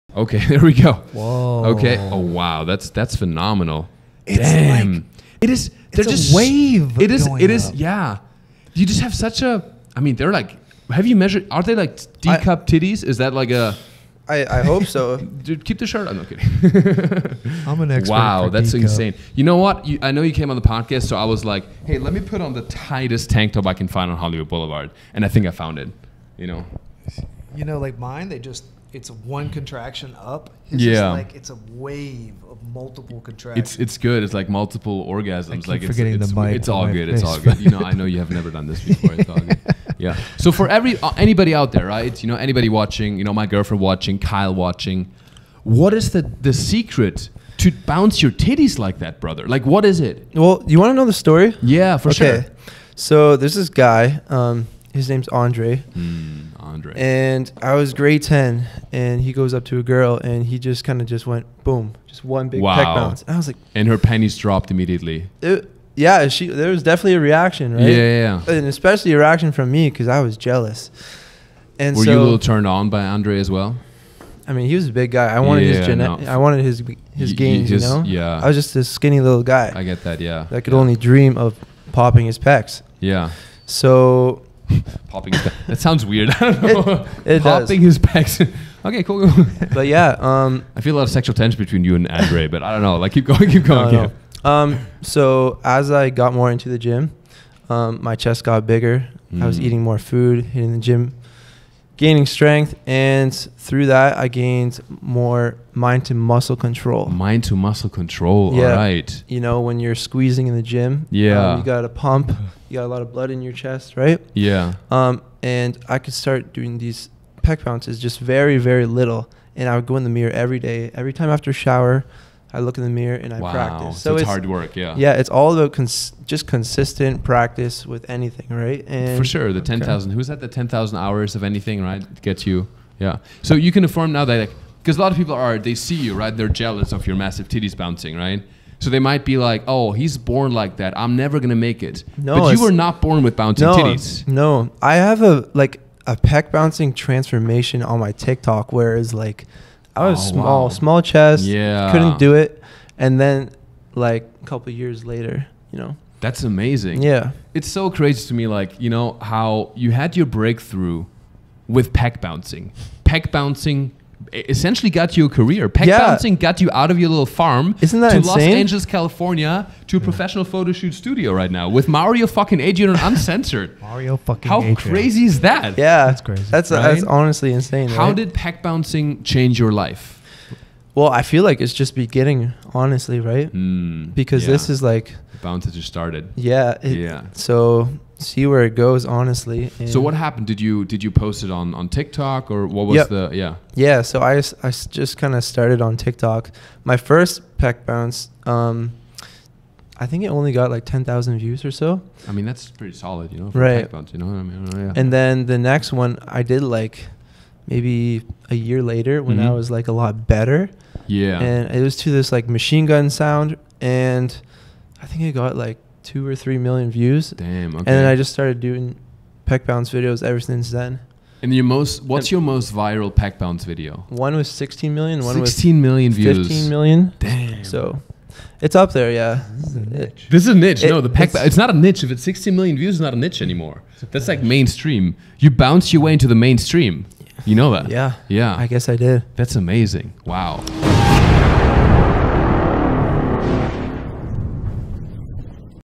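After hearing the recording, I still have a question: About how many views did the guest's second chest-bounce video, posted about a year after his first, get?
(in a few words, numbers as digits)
2 or 3 million.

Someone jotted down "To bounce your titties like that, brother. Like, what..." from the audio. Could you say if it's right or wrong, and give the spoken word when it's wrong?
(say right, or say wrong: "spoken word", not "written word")
right.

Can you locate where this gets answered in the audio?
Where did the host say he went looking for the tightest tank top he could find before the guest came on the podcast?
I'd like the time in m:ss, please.
0:24.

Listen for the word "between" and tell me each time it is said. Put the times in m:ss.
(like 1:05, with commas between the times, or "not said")
1:31.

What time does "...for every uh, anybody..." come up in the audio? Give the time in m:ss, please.
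0:40.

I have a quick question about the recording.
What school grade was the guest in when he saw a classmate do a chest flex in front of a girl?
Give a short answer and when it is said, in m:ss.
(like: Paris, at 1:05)
Grade 10, at 0:57.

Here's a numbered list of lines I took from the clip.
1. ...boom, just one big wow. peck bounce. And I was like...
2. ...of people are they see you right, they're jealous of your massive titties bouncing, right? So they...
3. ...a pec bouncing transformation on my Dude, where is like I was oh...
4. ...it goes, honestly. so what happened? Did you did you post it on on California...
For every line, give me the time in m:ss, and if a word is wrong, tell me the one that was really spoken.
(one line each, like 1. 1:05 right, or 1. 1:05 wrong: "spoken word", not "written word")
1. 1:01 right
2. 2:15 right
3. 2:26 wrong: "TikTok", not "Dude"
4. 3:08 wrong: "TikTok", not "California".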